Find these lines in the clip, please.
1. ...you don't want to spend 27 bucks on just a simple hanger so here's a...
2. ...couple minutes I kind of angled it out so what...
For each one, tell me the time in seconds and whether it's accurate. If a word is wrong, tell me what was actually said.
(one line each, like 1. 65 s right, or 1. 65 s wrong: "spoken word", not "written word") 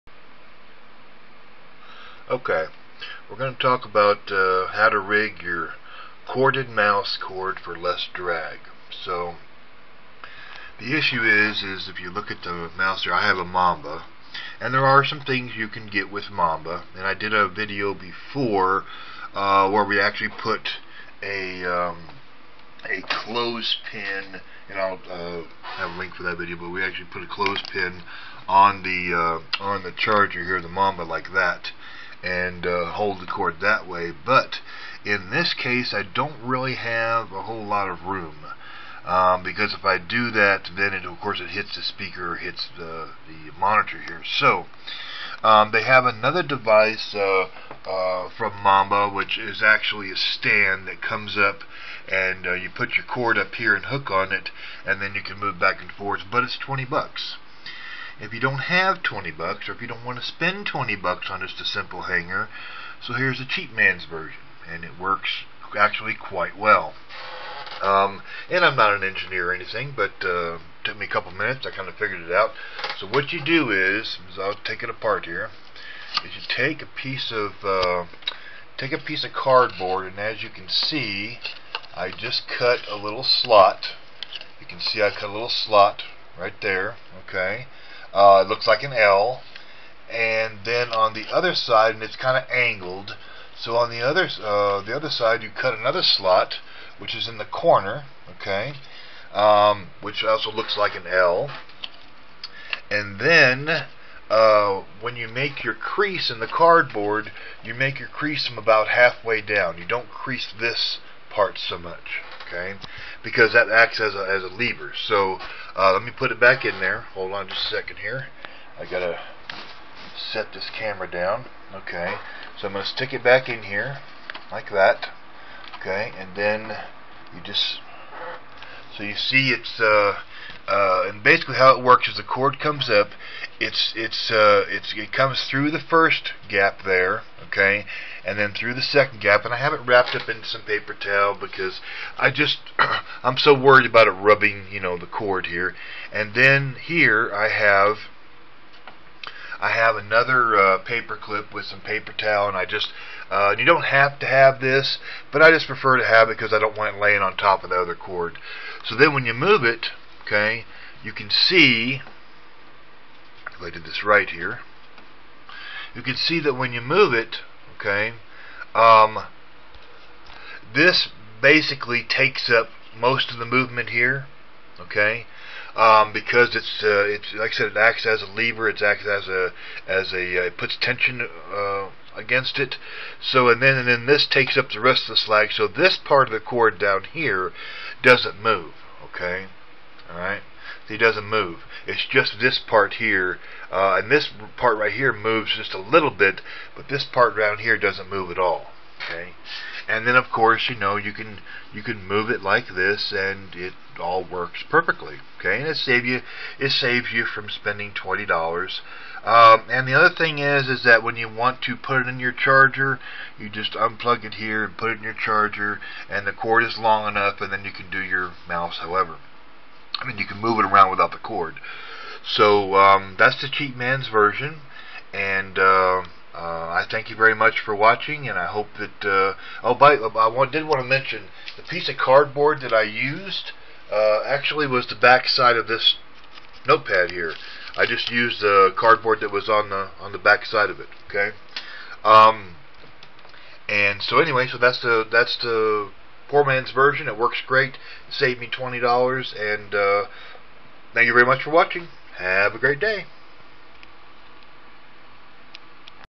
1. 59 s wrong: "20", not "27"
2. 71 s wrong: "figured", not "angled".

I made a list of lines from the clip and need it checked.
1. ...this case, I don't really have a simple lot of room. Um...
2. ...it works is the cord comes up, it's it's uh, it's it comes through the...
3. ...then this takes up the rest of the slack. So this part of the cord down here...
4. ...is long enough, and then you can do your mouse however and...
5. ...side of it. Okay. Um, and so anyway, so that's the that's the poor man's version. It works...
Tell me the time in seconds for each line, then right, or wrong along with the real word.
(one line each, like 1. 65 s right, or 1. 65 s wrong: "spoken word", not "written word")
1. 35 s wrong: "whole", not "simple"
2. 131 s right
3. 183 s right
4. 216 s right
5. 240 s right.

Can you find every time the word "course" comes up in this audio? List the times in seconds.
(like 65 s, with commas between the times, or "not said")
41 s, 200 s.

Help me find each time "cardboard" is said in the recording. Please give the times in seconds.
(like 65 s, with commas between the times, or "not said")
79 s, 106 s, 231 s, 238 s.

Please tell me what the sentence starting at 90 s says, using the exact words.
And then on the other side, and it's kind of angled.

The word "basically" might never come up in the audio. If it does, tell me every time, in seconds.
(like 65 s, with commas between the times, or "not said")
131 s, 171 s.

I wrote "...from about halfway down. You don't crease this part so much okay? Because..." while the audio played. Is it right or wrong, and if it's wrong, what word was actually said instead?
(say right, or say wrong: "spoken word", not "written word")
right.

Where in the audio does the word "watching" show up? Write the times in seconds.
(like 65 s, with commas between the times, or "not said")
227 s, 251 s.